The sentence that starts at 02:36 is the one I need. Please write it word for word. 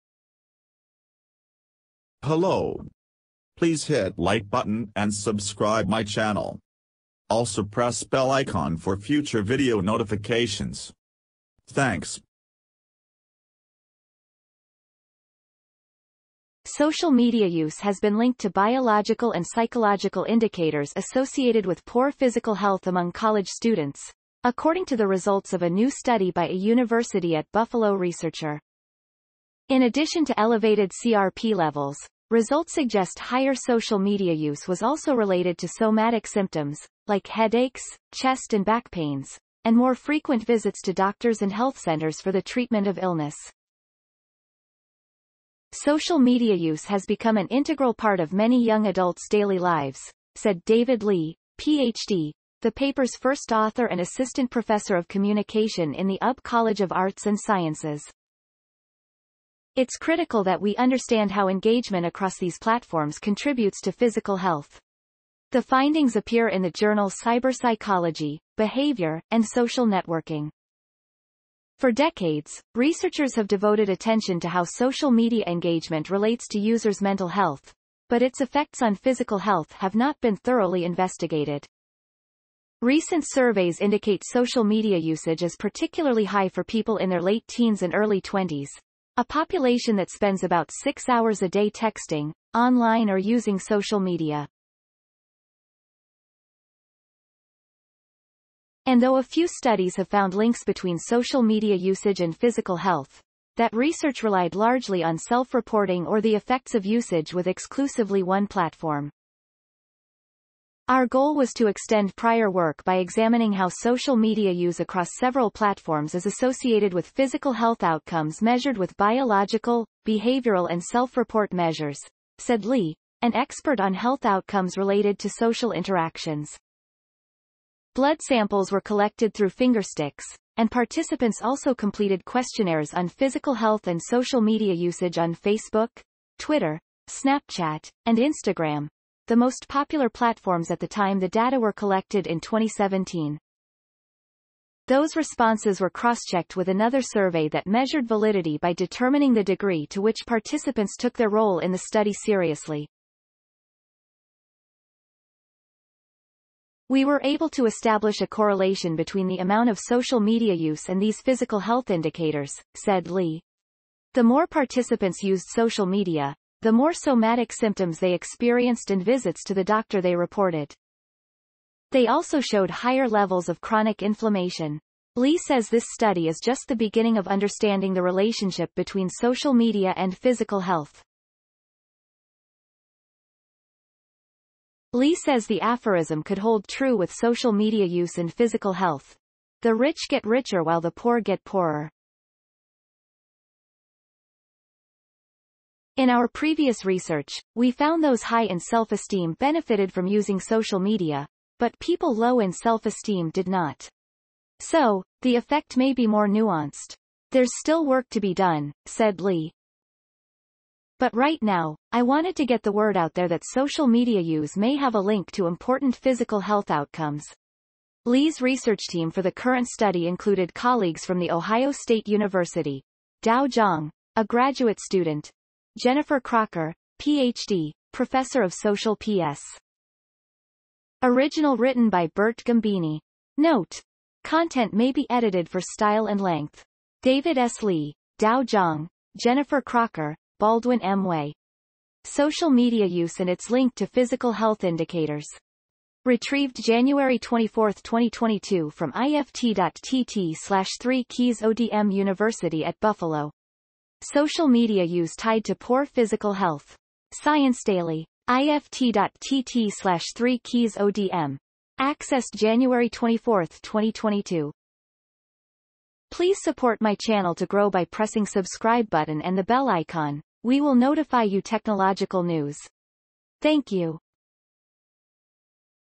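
We were able to establish a correlation between the amount of social media use and these physical health indicators, said Lee.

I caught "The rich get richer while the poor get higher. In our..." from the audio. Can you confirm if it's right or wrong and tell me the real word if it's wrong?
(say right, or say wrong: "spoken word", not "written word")
wrong: "poorer", not "higher".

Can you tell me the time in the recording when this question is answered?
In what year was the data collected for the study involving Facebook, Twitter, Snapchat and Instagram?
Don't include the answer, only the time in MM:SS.
02:22.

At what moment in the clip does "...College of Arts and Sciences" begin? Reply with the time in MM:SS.
00:56.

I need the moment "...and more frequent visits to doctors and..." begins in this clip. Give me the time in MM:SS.
00:39.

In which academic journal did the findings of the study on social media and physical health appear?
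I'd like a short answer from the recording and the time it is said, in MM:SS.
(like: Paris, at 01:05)
Cyberpsychology, Behavior, and Social Networking, at 01:07.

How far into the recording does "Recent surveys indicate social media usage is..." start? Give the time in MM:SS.
01:22.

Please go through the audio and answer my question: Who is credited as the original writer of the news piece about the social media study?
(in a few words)
Bert Gambini.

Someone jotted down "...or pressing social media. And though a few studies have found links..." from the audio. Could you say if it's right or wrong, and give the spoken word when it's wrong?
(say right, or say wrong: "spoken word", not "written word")
wrong: "using", not "pressing".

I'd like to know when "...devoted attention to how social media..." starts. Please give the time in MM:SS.
01:13.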